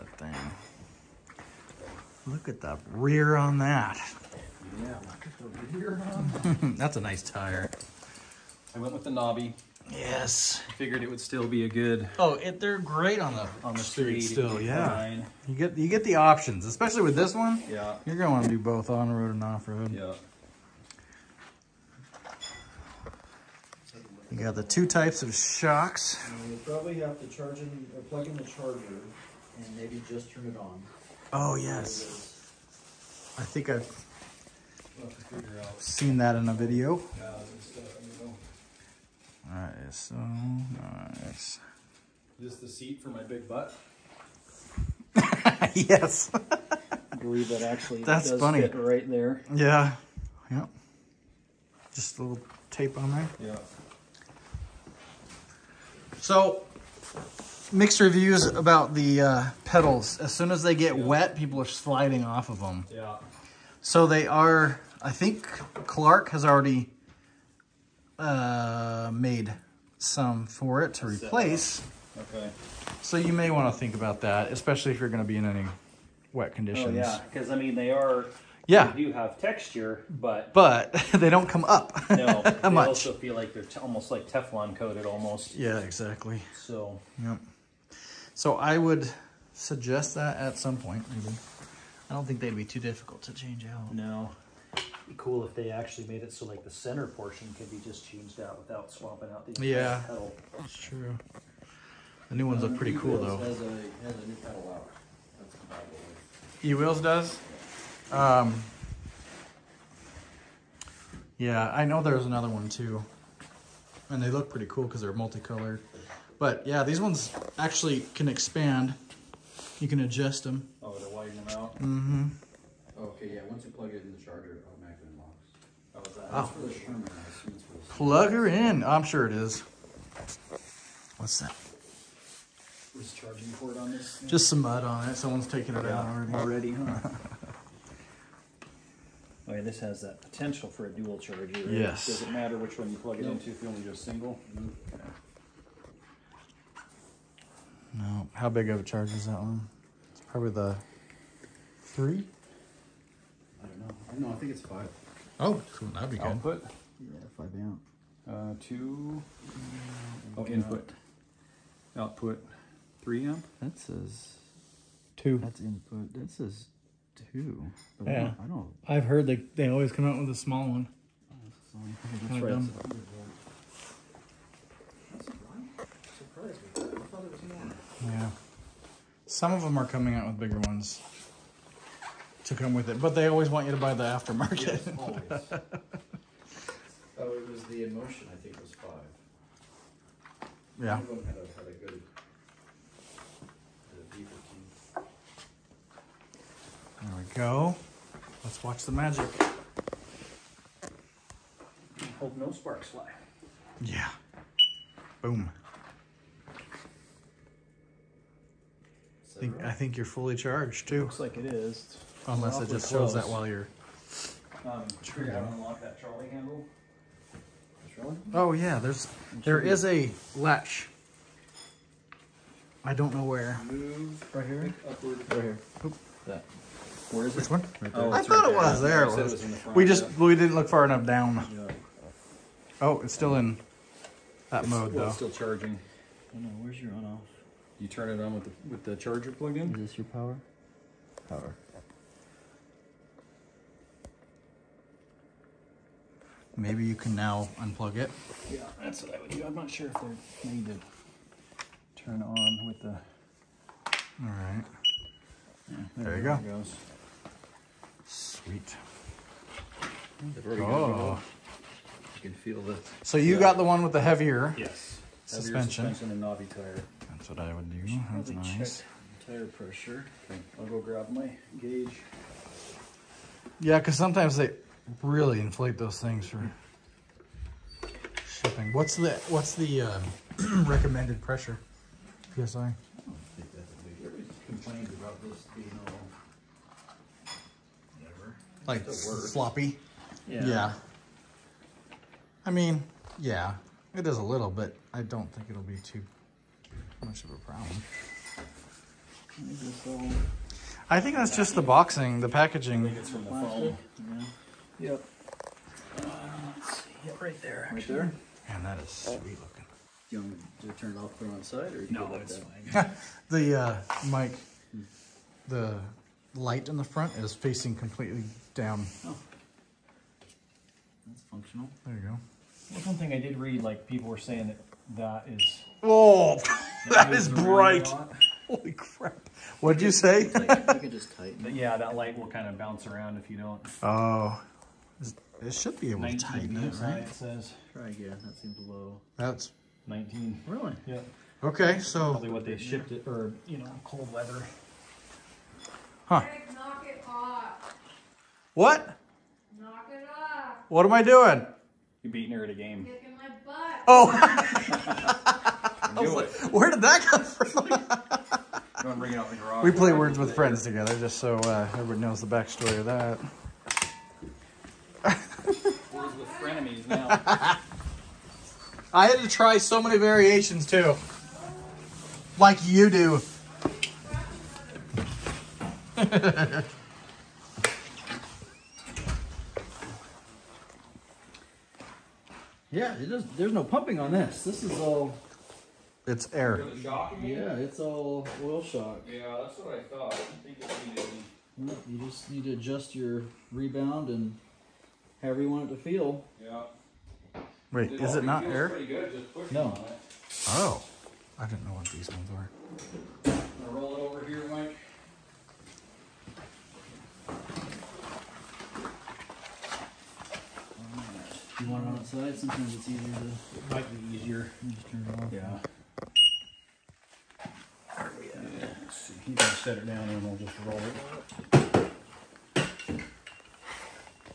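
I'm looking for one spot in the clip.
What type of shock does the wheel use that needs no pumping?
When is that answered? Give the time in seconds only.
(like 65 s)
388 s.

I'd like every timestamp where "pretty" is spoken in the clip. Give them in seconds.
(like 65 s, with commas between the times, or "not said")
102 s, 114 s.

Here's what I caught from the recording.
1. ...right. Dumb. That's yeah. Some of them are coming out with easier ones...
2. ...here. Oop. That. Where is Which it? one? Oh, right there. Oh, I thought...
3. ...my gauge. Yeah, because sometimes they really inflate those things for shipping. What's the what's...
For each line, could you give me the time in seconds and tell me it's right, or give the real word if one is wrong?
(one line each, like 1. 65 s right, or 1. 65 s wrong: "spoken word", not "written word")
1. 172 s wrong: "bigger", not "easier"
2. 225 s right
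3. 271 s right.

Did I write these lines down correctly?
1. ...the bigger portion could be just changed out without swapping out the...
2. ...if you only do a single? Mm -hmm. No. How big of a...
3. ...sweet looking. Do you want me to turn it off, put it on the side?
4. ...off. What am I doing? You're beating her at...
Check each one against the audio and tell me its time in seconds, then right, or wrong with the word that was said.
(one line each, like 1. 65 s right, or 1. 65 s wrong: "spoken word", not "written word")
1. 96 s wrong: "center", not "bigger"
2. 143 s right
3. 308 s right
4. 350 s right.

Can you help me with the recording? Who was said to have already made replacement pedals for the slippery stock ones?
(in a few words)
Clark.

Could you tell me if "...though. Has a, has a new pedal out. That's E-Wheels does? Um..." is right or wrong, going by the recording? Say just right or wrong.
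right.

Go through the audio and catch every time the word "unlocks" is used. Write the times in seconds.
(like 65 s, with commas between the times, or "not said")
125 s, 215 s.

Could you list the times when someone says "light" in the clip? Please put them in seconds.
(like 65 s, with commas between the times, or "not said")
316 s, 331 s.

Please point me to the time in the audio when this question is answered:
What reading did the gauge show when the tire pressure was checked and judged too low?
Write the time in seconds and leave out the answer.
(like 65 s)
339 s.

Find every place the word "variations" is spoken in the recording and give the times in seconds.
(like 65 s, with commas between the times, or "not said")
369 s.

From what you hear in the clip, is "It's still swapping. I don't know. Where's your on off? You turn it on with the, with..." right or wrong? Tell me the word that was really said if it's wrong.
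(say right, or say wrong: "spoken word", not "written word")
wrong: "charging", not "swapping".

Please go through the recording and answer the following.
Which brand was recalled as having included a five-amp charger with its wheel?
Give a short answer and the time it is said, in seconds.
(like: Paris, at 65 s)
InMotion, at 187 s.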